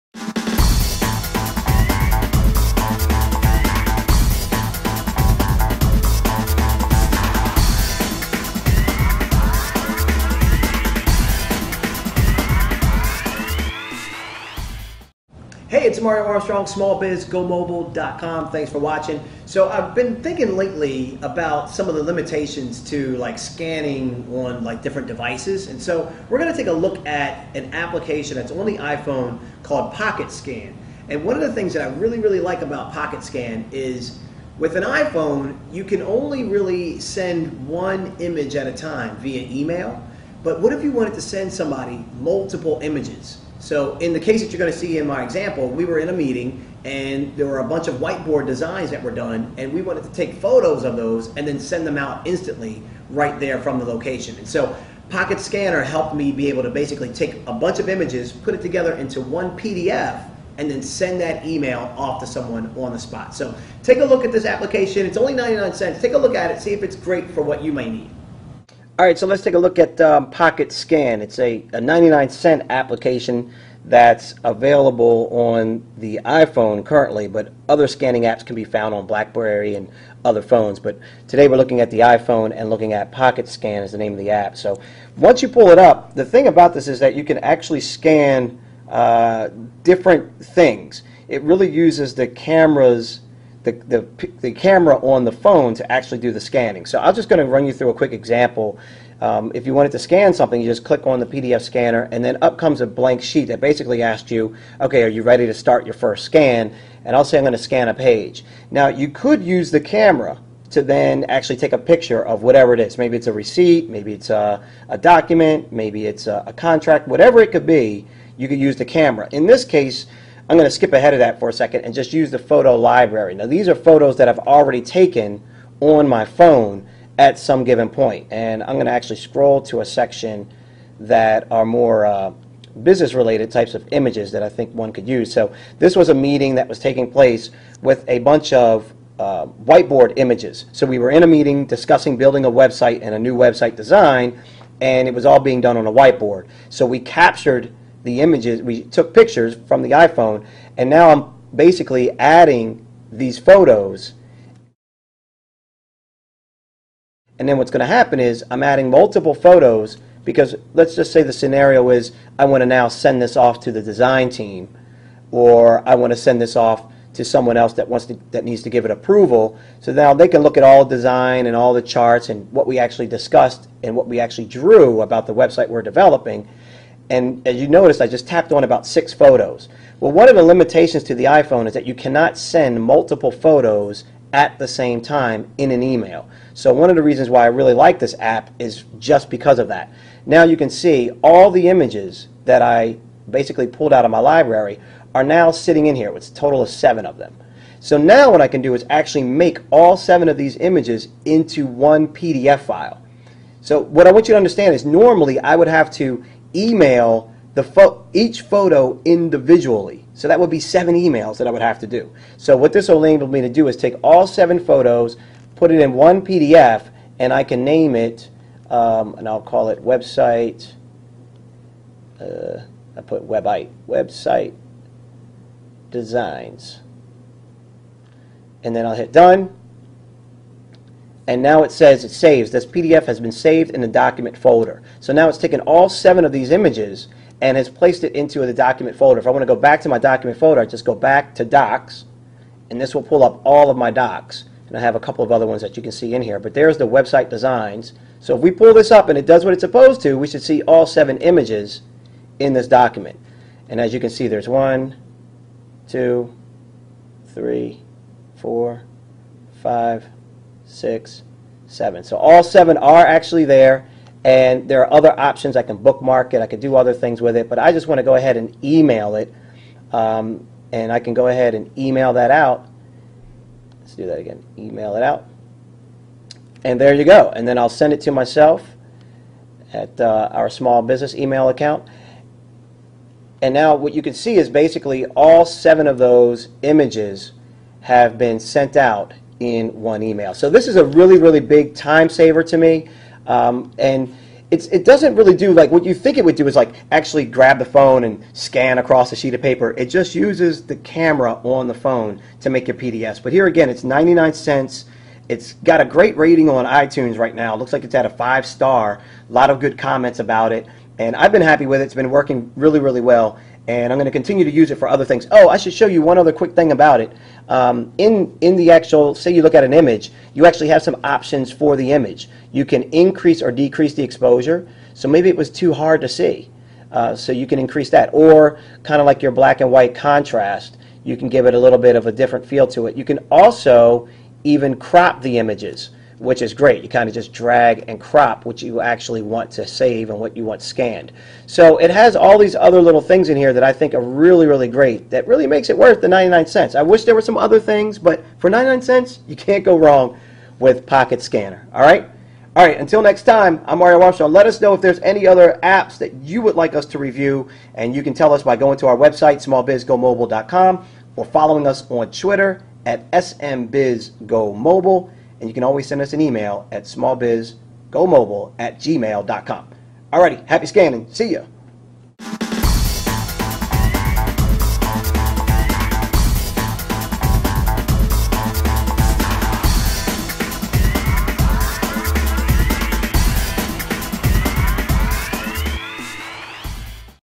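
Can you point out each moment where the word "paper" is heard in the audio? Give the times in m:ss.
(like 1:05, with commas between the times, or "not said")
4:59.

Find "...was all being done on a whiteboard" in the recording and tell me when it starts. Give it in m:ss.
2:25.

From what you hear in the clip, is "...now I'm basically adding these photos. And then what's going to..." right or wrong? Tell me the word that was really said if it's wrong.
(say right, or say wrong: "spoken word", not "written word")
right.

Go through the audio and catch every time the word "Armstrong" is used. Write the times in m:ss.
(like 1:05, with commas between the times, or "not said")
0:16, 5:53.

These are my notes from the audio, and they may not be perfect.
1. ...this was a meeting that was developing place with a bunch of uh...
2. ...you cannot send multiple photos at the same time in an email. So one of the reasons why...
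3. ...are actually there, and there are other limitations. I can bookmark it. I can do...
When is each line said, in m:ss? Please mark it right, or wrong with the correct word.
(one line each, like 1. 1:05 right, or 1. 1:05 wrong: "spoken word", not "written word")
1. 2:15 wrong: "taking", not "developing"
2. 3:01 right
3. 4:22 wrong: "options", not "limitations".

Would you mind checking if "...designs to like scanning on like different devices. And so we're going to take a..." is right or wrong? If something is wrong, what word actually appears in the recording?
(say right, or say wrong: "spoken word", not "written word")
wrong: "limitations", not "designs".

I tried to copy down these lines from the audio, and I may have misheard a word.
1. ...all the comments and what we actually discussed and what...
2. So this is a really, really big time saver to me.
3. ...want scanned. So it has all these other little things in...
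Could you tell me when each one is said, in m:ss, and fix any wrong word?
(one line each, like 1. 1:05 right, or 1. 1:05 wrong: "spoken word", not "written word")
1. 2:51 wrong: "charts", not "comments"
2. 4:50 right
3. 5:40 right.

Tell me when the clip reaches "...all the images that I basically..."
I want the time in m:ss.
3:11.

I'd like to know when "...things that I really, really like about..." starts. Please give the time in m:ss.
0:31.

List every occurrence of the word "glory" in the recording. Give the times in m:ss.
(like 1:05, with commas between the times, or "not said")
not said.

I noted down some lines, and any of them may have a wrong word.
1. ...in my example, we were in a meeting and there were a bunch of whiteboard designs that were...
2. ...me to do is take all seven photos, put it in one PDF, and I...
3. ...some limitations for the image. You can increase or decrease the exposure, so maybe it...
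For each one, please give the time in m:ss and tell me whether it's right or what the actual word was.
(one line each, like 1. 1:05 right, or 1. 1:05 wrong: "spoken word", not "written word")
1. 0:44 right
2. 3:33 right
3. 5:20 wrong: "options", not "limitations".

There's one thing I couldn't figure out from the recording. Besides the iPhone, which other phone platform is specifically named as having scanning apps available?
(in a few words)
BlackBerry.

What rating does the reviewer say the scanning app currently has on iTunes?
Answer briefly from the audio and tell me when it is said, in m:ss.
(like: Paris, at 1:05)
5 star, at 5:08.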